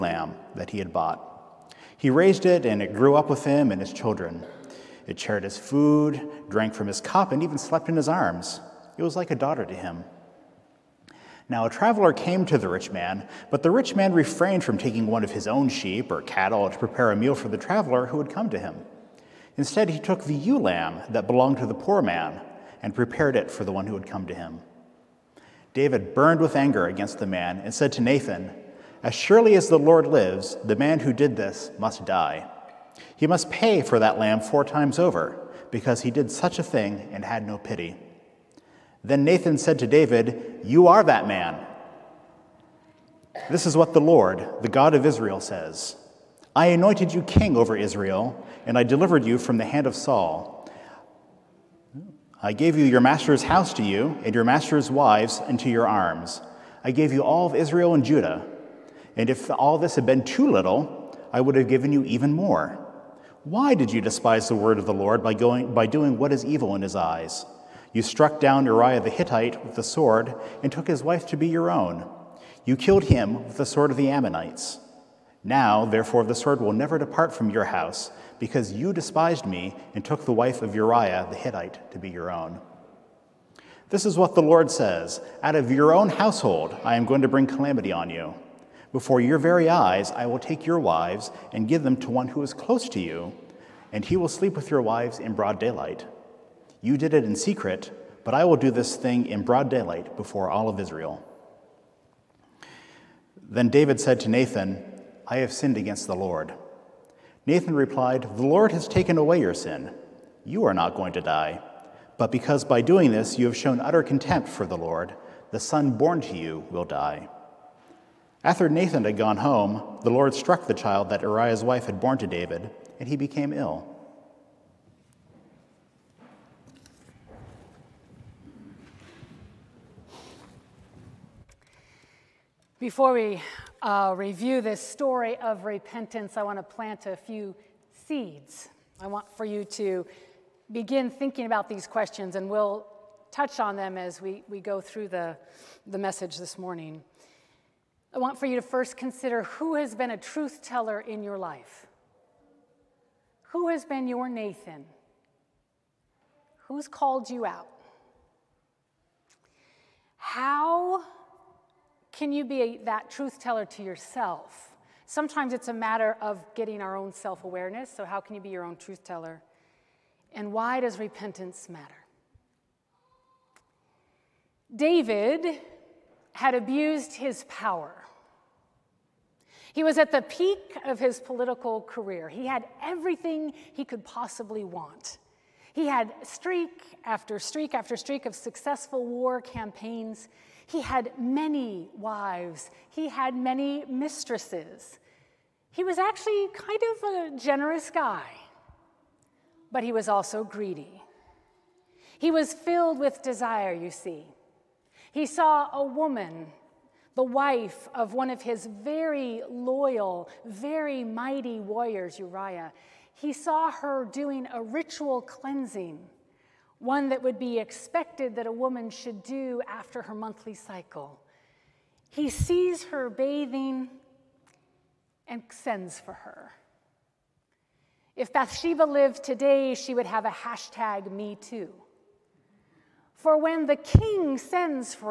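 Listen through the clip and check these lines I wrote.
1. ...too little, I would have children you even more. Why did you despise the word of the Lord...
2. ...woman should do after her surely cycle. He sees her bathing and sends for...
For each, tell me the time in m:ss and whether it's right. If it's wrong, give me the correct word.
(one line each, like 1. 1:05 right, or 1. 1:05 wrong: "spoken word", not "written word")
1. 1:00 wrong: "given", not "children"
2. 3:38 wrong: "monthly", not "surely".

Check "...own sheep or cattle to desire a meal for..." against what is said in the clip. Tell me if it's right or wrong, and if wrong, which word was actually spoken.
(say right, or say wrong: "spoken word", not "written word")
wrong: "prepare", not "desire".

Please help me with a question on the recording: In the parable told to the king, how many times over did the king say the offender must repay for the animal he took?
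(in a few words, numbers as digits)
4.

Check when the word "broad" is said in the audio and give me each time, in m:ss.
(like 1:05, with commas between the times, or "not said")
1:35, 1:39.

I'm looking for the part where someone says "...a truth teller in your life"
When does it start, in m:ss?
2:30.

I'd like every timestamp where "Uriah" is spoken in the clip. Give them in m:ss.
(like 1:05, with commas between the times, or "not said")
1:08, 1:20, 2:01, 3:32.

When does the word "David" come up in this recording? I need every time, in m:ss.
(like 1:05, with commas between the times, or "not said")
0:25, 0:39, 1:43, 2:02, 2:54.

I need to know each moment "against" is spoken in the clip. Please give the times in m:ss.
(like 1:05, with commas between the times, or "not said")
0:26, 1:45.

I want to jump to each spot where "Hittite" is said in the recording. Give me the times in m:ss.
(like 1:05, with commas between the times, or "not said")
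1:09, 1:21.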